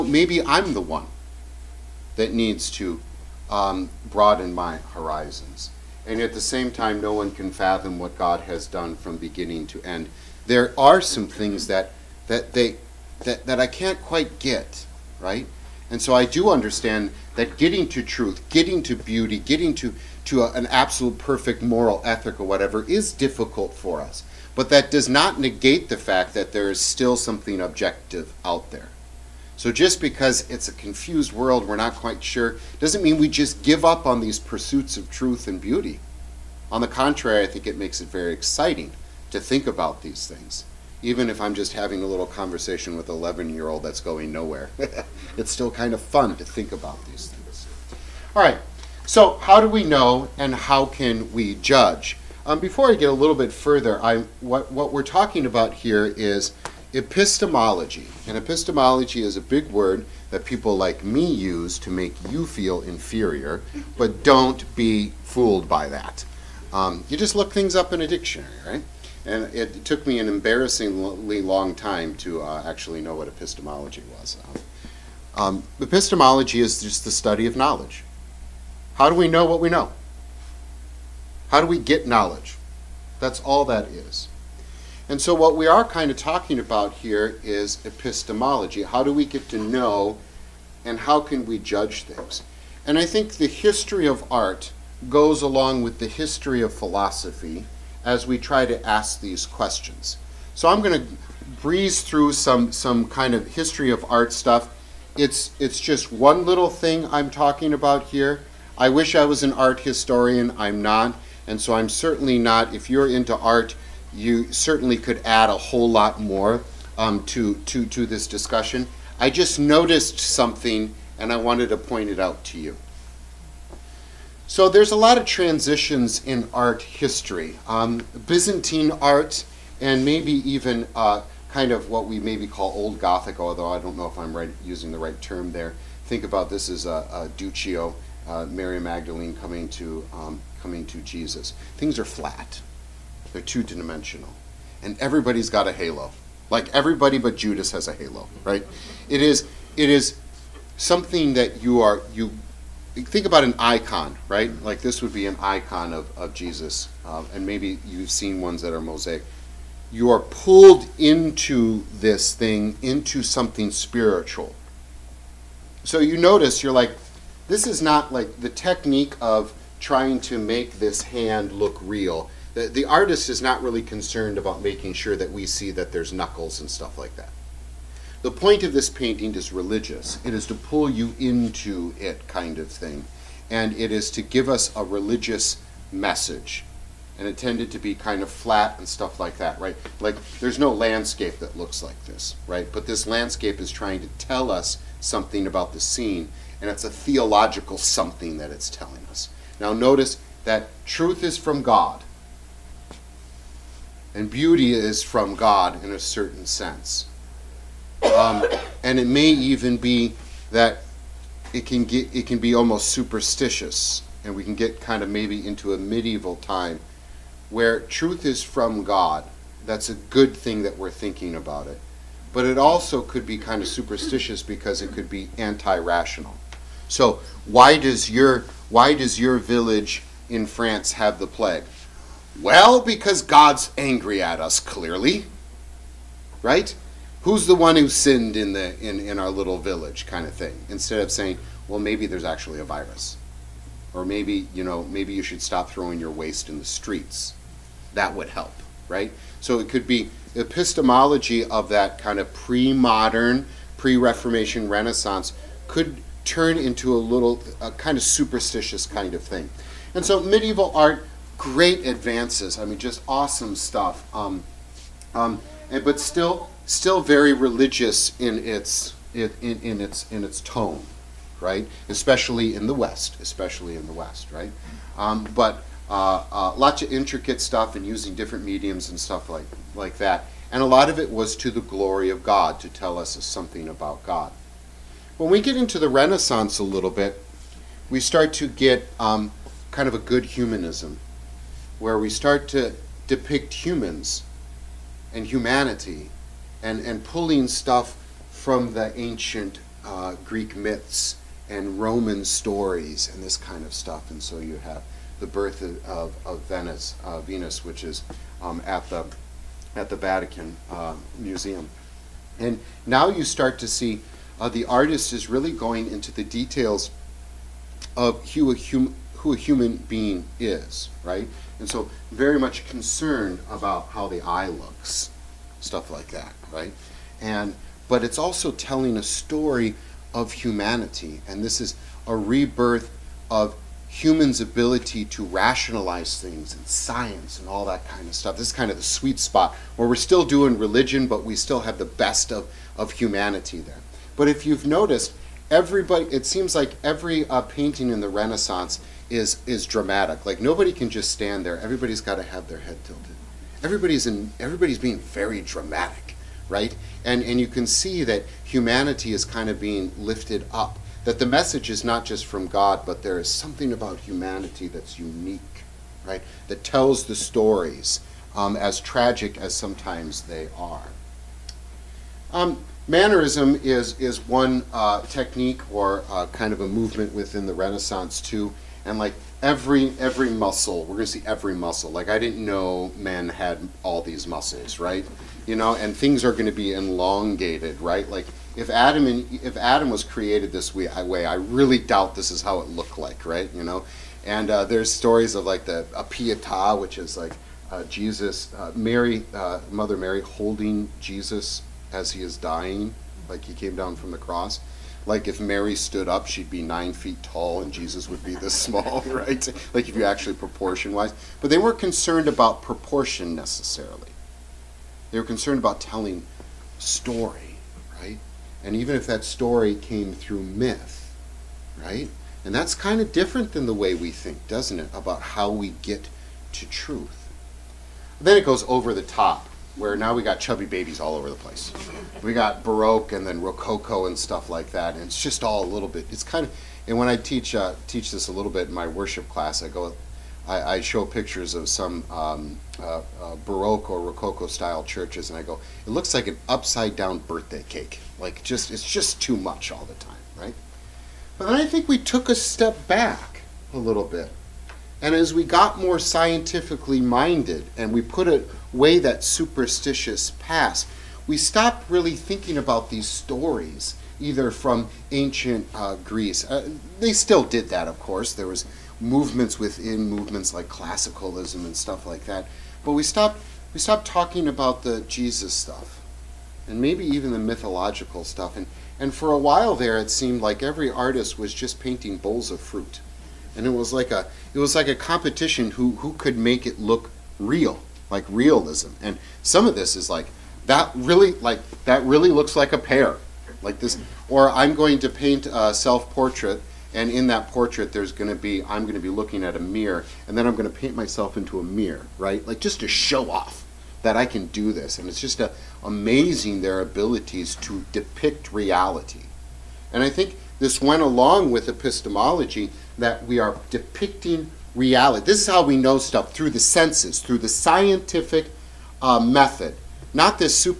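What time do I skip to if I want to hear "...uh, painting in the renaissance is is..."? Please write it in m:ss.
5:47.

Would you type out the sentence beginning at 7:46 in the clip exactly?
Uh, they still did that, of course.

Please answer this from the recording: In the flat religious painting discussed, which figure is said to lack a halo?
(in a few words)
Judas.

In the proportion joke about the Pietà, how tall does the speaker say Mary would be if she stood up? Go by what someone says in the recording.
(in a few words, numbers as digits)
9 feet.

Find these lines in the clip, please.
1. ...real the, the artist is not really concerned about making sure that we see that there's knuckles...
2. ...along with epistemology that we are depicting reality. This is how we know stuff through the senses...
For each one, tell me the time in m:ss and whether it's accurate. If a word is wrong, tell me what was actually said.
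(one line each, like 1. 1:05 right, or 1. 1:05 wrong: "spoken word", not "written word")
1. 2:51 right
2. 8:31 right.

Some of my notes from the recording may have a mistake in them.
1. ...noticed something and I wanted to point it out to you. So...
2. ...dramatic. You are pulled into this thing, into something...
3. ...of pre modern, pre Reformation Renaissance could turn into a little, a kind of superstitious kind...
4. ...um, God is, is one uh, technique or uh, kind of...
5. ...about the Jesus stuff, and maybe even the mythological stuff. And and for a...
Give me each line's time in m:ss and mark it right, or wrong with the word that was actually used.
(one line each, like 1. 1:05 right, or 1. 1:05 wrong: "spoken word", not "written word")
1. 1:59 right
2. 2:38 wrong: "mosaic", not "dramatic"
3. 4:12 right
4. 6:12 wrong: "Mannerism", not "God"
5. 7:54 right.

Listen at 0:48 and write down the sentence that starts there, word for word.
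All right, so how do we know and how can we judge?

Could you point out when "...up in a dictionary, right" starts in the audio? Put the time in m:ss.
1:07.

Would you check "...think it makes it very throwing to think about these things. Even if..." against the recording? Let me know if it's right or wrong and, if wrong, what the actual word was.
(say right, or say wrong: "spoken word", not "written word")
wrong: "exciting", not "throwing".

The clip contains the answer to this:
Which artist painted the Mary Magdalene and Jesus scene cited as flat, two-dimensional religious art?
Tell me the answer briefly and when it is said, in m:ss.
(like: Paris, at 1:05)
Duccio, at 2:17.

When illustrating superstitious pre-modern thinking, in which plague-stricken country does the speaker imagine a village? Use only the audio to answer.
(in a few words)
France.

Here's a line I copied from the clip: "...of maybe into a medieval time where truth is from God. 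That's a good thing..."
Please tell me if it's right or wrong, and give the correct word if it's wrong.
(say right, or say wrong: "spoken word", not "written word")
right.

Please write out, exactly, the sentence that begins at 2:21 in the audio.
Things are flat, they're two dimensional.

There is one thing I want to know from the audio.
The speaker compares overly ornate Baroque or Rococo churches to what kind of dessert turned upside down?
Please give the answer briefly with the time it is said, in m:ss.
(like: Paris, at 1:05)
Birthday cake, at 7:26.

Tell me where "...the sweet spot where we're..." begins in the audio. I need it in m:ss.
5:38.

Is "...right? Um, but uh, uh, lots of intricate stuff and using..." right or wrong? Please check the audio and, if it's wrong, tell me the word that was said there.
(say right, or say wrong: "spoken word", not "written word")
right.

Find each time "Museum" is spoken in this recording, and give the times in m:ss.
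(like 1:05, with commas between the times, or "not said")
5:11.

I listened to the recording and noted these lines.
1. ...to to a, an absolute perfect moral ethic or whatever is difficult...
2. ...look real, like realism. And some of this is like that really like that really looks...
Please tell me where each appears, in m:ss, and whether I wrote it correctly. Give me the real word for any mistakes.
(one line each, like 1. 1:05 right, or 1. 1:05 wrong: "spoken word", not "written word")
1. 0:19 right
2. 8:06 right.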